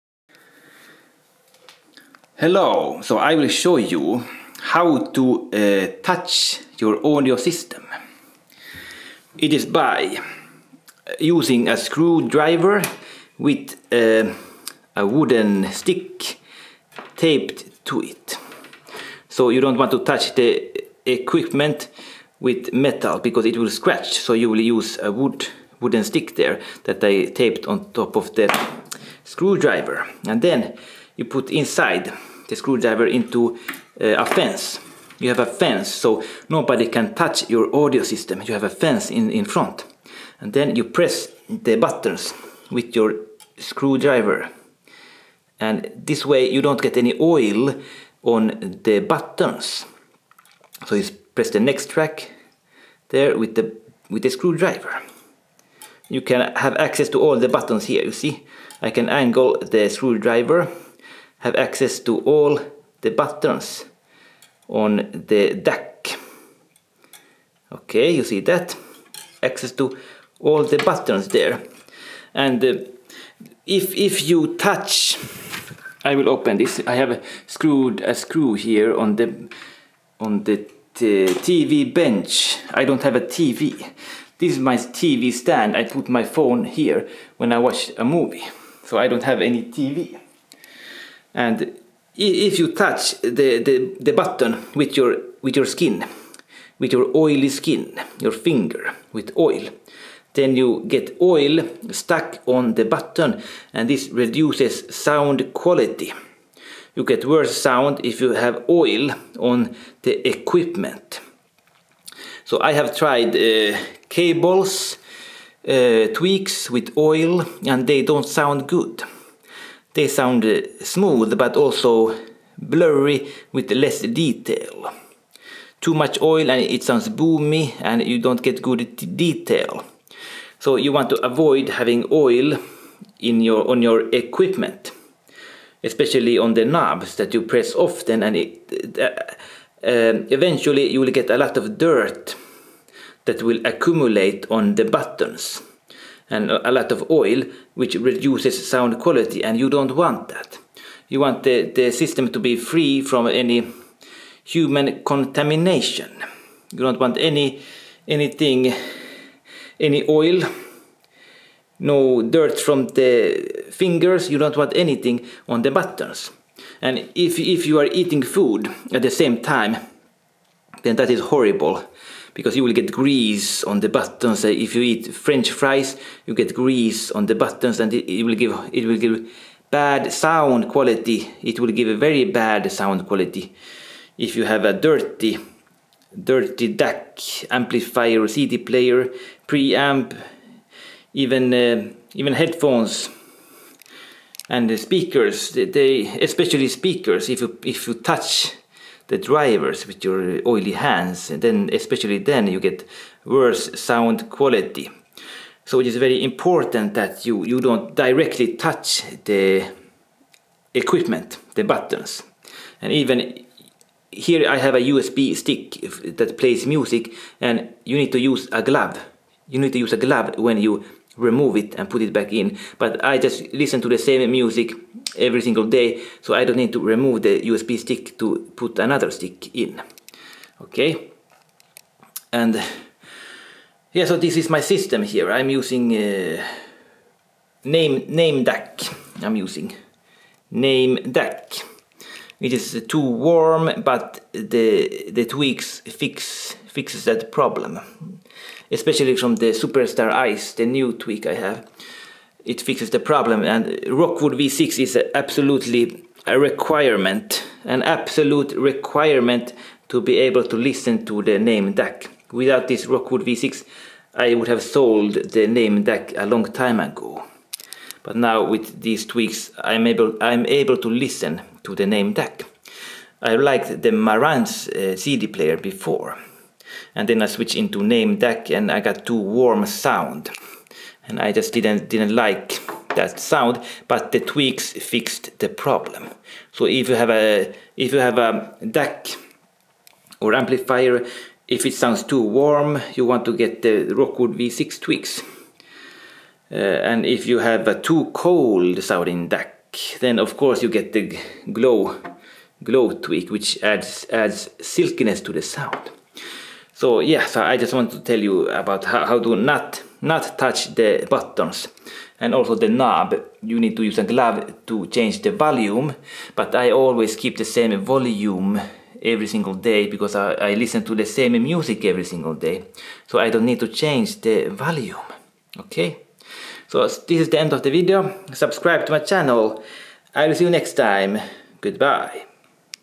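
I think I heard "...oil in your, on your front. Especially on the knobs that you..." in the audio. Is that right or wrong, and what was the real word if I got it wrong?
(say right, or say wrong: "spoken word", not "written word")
wrong: "equipment", not "front".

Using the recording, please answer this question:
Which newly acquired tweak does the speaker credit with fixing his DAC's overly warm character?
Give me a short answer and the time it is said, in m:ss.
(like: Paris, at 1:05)
Superstar Ice, at 4:09.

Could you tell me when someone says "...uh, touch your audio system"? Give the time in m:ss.
0:05.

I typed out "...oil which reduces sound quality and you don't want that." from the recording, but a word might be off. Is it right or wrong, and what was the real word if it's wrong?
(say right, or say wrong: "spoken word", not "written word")
right.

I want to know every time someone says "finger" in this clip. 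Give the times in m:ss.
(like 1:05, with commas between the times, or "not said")
1:38, 2:43.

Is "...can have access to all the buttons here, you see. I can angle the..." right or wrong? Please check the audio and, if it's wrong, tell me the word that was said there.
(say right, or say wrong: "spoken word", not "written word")
right.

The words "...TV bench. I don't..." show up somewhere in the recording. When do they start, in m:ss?
1:20.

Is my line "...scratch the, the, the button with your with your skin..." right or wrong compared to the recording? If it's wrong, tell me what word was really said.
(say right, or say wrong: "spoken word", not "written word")
wrong: "touch", not "scratch".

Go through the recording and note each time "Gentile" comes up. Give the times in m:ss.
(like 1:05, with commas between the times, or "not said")
not said.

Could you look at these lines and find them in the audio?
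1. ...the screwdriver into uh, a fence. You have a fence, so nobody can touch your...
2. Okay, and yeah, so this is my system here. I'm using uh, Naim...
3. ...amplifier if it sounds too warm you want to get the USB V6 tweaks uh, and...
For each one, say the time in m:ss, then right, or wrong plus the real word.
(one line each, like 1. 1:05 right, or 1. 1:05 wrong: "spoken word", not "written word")
1. 0:32 right
2. 3:50 right
3. 4:50 wrong: "Rockwood", not "USB".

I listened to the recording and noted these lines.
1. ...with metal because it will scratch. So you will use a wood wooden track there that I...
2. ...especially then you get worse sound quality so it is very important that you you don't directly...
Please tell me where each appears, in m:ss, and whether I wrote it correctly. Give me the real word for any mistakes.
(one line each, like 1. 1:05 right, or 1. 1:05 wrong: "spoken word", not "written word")
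1. 0:22 wrong: "stick", not "track"
2. 3:21 right.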